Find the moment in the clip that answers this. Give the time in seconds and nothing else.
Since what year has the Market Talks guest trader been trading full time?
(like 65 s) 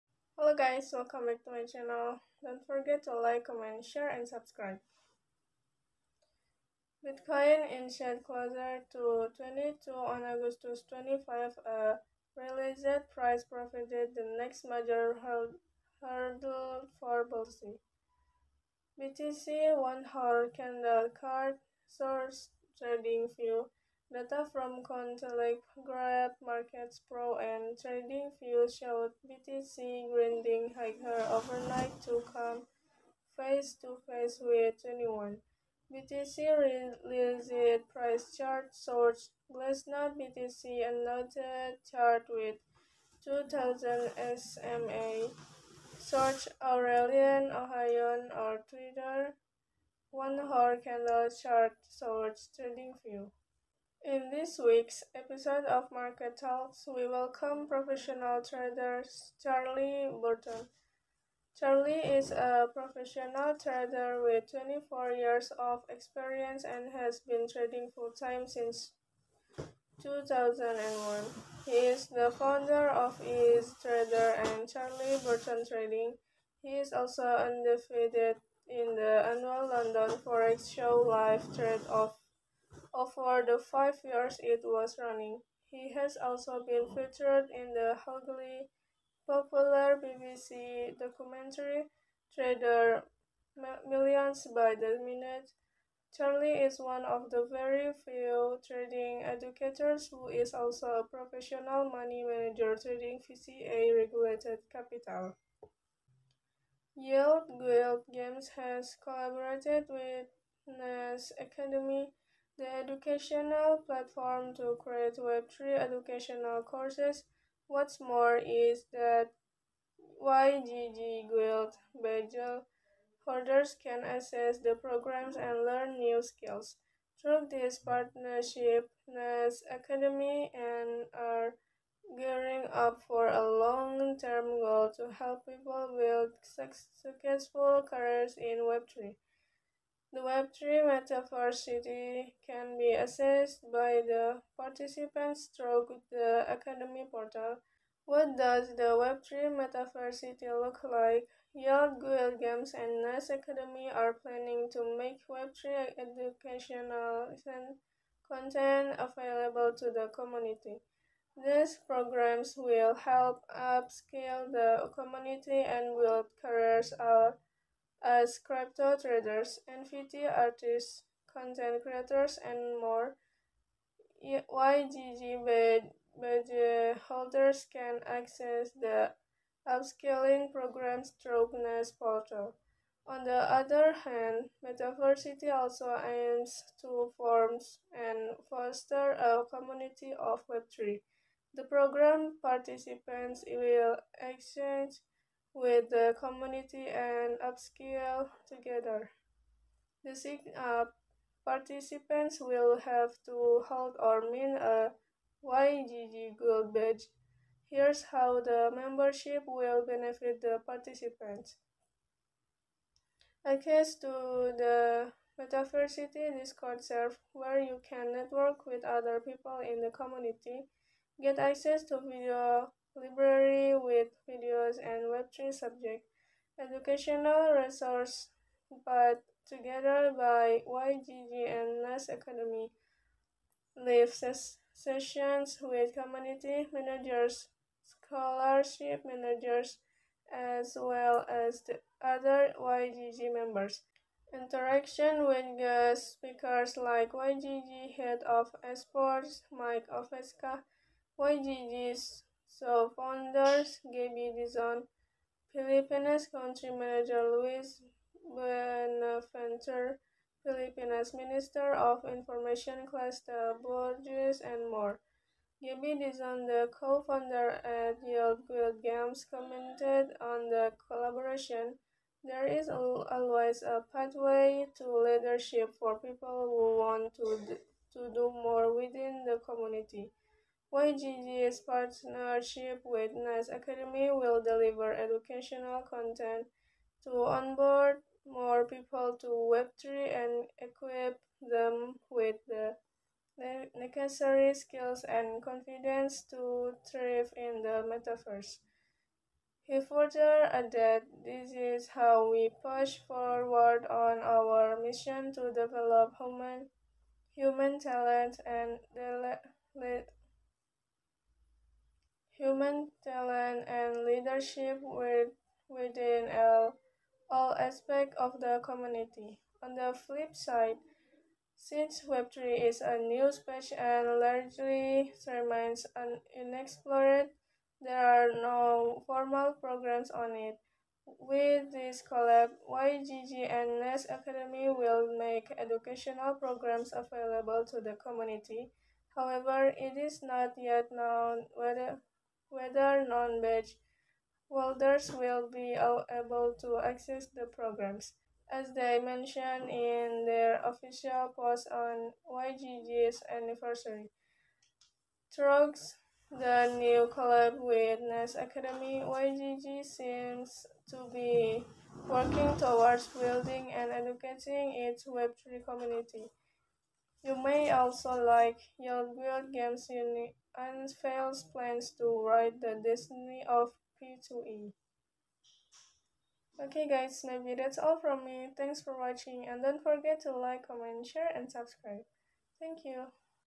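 70 s.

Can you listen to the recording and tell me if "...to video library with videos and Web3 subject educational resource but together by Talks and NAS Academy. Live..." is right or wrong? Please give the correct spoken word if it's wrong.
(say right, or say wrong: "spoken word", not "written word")
wrong: "YGG", not "Talks".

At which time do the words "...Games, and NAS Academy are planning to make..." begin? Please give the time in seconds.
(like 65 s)
152 s.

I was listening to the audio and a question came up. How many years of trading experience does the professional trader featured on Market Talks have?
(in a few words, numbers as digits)
24.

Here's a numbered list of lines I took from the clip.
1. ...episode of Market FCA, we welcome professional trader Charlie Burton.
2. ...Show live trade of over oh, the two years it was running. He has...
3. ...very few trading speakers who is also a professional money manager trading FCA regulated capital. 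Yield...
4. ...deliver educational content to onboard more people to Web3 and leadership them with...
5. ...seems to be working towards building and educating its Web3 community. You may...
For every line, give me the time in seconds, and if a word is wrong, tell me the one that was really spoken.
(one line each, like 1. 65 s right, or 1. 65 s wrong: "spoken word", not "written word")
1. 55 s wrong: "Talks", not "FCA"
2. 80 s wrong: "five", not "two"
3. 97 s wrong: "educators", not "speakers"
4. 284 s wrong: "equip", not "leadership"
5. 359 s right.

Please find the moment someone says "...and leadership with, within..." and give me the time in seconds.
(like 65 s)
313 s.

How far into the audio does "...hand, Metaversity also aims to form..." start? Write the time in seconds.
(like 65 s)
184 s.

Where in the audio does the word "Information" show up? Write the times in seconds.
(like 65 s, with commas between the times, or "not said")
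262 s.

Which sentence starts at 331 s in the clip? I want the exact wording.
With this collab, YGG and NAS Academy will make educational programs available to the community.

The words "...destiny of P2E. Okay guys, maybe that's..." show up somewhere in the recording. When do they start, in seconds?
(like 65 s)
372 s.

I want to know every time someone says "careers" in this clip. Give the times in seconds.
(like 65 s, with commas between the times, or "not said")
137 s, 166 s.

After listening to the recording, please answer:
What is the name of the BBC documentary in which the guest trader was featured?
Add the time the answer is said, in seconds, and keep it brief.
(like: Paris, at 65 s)
Trader Millions by the Minute, at 92 s.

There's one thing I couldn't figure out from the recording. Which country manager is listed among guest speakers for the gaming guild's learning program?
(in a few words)
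Luis Buenaventura.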